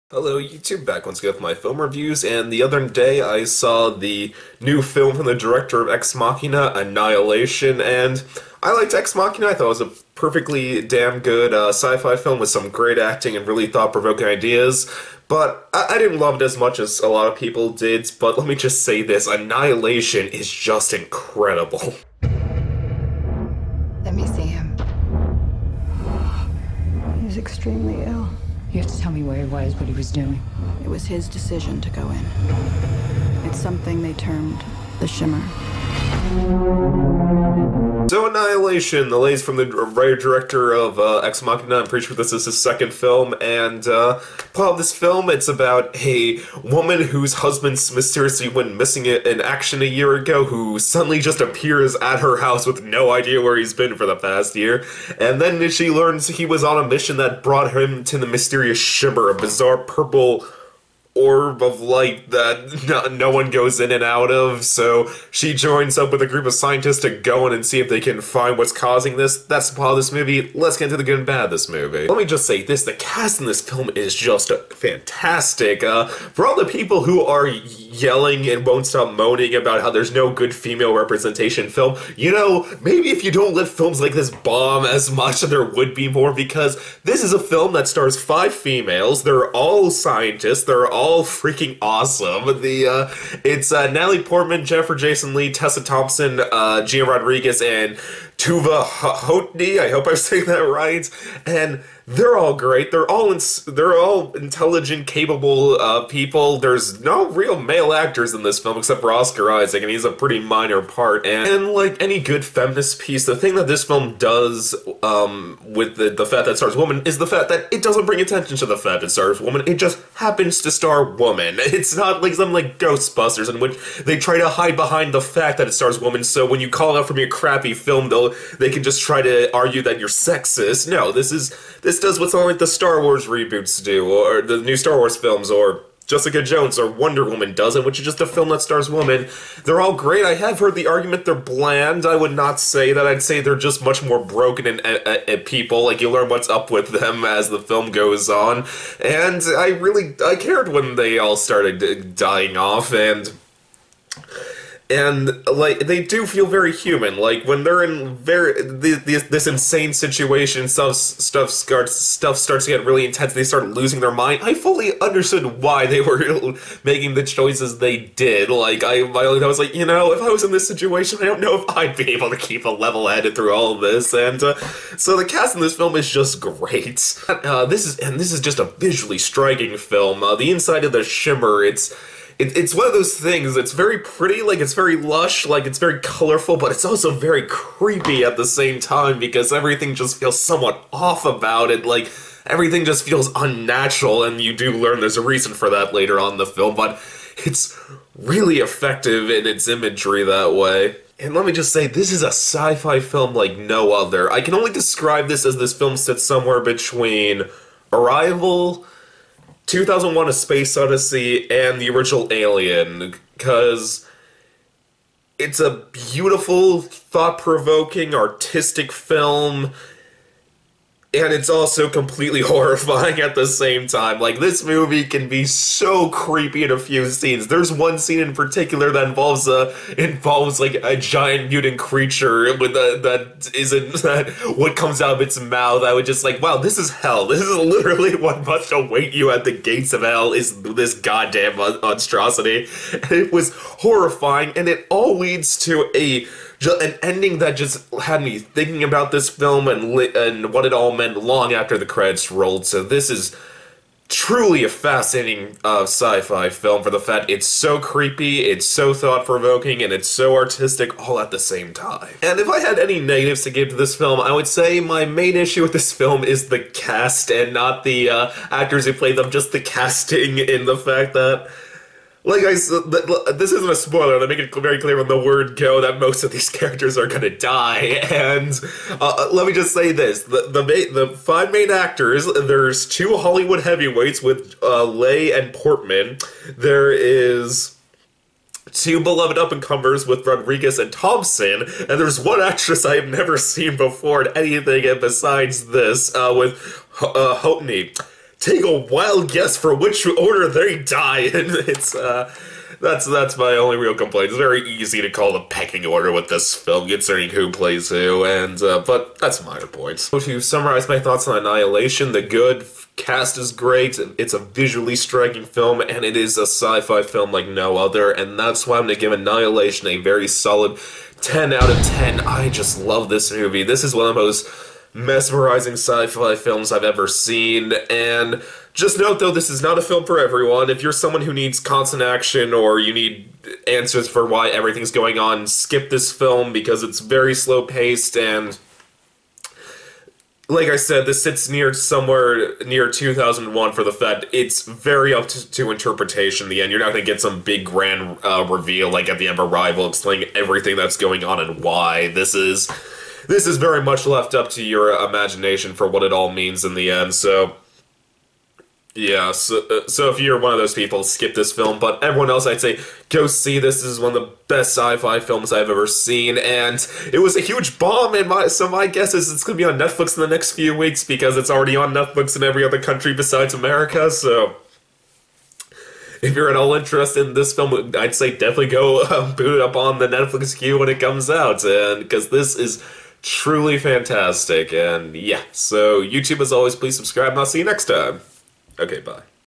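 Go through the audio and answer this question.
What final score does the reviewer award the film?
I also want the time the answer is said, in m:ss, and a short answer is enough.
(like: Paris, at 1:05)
10 out of 10, at 5:21.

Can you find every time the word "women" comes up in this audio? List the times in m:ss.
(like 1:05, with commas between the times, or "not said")
2:18.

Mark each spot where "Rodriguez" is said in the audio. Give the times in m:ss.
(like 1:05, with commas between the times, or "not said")
1:37, 4:50.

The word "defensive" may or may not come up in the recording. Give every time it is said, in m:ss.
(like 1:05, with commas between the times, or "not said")
not said.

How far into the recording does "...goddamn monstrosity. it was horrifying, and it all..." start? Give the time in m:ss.
4:00.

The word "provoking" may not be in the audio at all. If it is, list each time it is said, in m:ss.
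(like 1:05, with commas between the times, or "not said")
0:13, 3:37, 4:18.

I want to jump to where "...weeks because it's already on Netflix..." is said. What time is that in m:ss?
6:10.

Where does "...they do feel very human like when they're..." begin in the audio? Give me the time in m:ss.
2:35.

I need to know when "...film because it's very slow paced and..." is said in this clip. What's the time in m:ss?
5:36.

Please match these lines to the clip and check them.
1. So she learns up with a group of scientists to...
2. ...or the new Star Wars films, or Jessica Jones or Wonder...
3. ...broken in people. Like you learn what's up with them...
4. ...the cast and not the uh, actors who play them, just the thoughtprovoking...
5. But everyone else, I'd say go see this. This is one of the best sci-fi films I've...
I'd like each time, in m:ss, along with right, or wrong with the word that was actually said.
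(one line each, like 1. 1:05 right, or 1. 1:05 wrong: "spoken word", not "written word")
1. 1:04 wrong: "joins", not "learns"
2. 2:14 right
3. 2:24 right
4. 4:26 wrong: "casting", not "thoughtprovoking"
5. 6:01 right.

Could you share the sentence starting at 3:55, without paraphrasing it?
I was just like, wow, this is hell.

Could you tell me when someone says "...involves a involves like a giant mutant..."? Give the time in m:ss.
3:49.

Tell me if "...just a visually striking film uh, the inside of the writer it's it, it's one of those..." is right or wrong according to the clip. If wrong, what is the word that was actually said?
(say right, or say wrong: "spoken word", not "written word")
wrong: "shimmer", not "writer".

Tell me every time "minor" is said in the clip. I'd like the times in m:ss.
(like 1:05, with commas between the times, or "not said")
1:50, 5:09.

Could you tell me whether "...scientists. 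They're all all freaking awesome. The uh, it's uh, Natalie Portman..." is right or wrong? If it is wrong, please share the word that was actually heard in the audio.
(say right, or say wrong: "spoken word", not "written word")
right.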